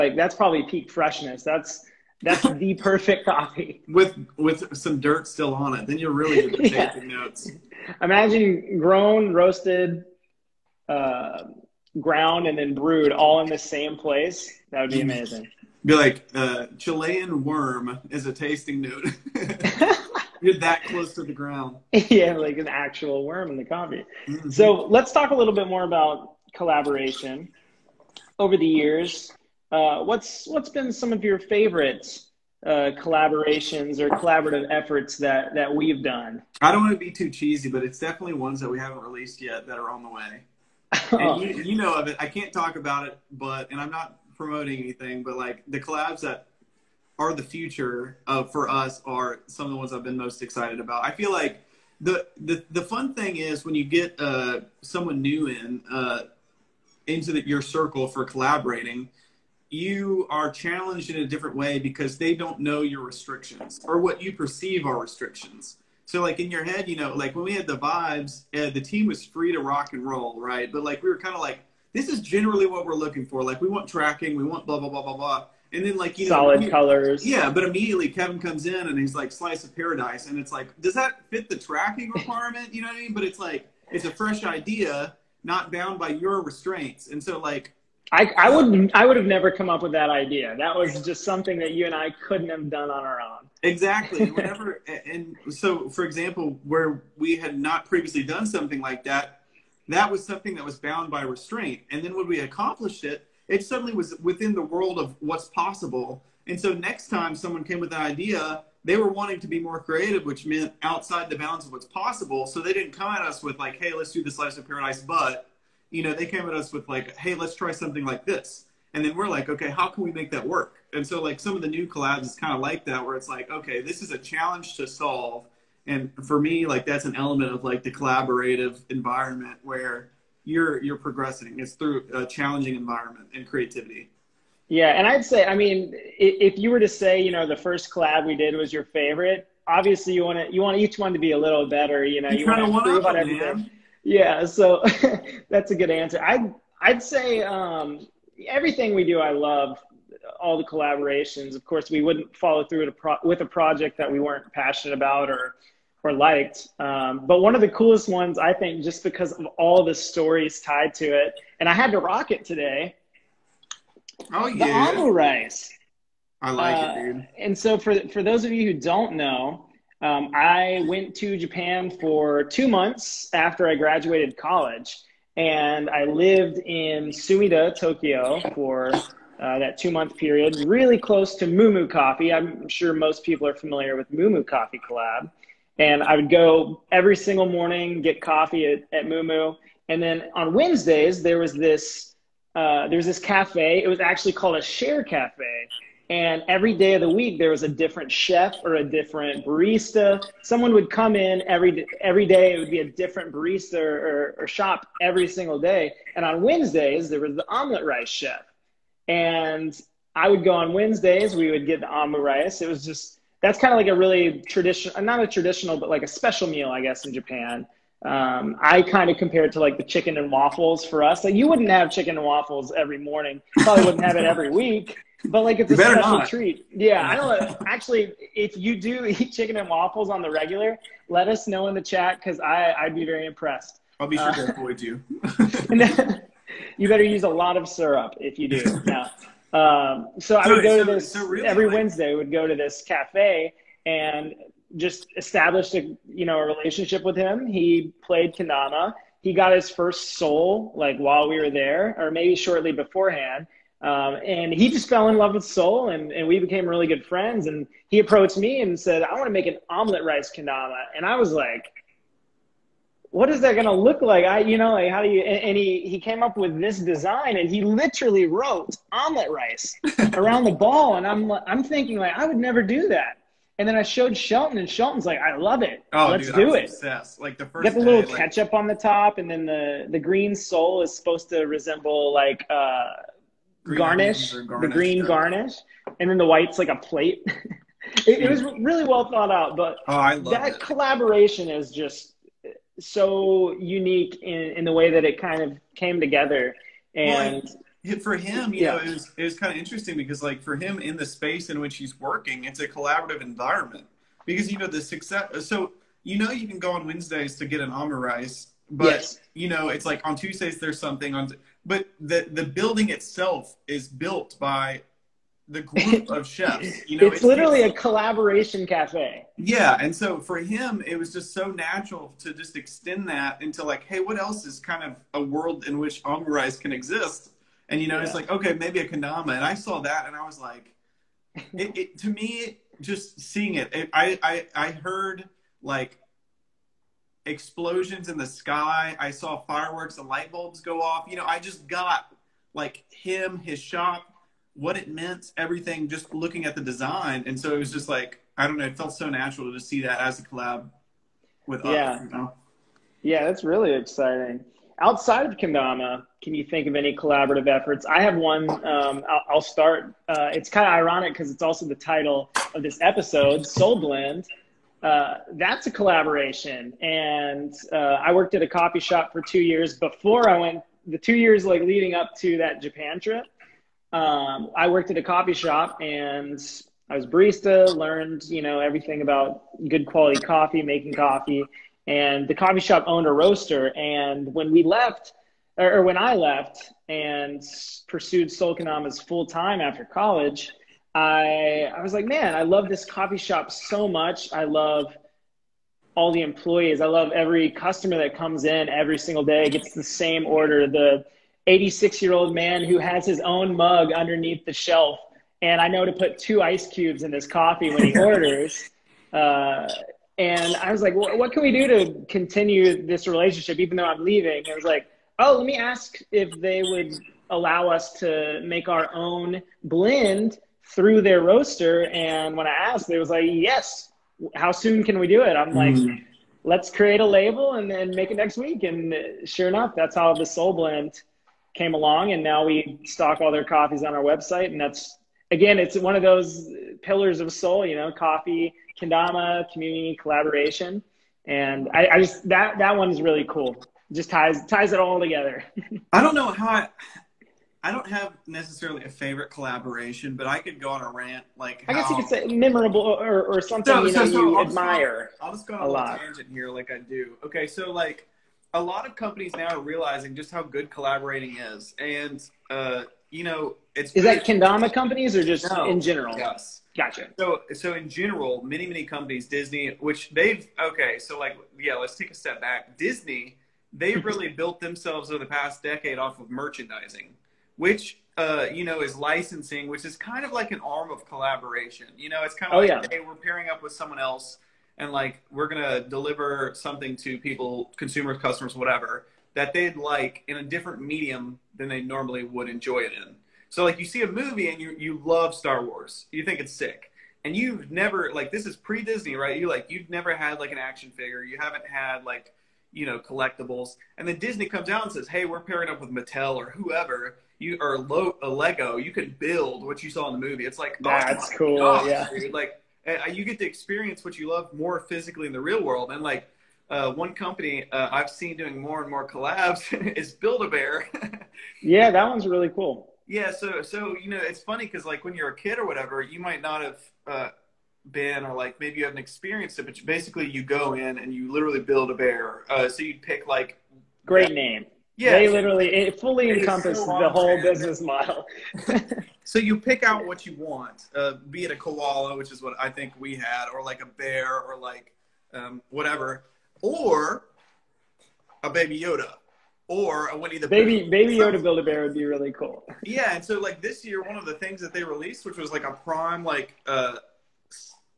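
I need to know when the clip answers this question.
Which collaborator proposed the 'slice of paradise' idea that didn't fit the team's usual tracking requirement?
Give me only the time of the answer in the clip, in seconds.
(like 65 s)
78 s.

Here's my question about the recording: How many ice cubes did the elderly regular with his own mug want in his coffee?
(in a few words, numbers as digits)
2.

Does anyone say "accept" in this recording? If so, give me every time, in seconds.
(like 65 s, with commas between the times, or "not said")
not said.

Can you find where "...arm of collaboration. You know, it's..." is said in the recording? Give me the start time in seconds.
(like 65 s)
480 s.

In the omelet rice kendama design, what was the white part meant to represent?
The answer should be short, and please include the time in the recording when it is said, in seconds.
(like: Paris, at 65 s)
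A plate, at 286 s.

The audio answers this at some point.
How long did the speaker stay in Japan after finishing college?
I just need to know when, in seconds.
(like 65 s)
172 s.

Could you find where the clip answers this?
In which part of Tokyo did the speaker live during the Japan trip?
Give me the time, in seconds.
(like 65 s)
177 s.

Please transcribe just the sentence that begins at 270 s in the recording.
And I'm, I'm thinking like, I would never do that.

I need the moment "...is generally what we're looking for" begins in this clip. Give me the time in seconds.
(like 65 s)
72 s.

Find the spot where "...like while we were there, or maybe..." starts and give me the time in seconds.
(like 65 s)
250 s.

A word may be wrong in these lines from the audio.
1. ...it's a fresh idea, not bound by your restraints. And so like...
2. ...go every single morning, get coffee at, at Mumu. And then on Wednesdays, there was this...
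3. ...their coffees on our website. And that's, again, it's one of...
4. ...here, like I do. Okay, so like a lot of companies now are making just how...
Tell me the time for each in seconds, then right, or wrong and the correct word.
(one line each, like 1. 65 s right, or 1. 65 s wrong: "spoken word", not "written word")
1. 83 s right
2. 186 s right
3. 433 s right
4. 456 s wrong: "realizing", not "making".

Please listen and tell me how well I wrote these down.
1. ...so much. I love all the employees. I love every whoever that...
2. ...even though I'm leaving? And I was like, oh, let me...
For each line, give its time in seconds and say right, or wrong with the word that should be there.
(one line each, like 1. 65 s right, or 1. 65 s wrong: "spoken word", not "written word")
1. 393 s wrong: "customer", not "whoever"
2. 413 s right.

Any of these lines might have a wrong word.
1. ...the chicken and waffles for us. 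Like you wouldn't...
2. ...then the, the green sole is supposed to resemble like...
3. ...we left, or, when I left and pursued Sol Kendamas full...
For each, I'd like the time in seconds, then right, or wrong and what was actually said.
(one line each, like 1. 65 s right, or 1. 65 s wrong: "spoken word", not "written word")
1. 219 s right
2. 279 s right
3. 384 s right.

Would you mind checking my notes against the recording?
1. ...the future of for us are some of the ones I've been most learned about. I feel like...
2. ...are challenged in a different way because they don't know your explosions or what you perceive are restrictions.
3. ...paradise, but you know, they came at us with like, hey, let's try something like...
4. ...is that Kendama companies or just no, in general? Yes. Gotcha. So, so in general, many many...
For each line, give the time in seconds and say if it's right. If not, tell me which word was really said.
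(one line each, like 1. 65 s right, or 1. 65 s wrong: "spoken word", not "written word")
1. 47 s wrong: "excited", not "learned"
2. 60 s wrong: "restrictions", not "explosions"
3. 114 s right
4. 463 s right.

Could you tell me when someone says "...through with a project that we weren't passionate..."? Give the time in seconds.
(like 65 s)
152 s.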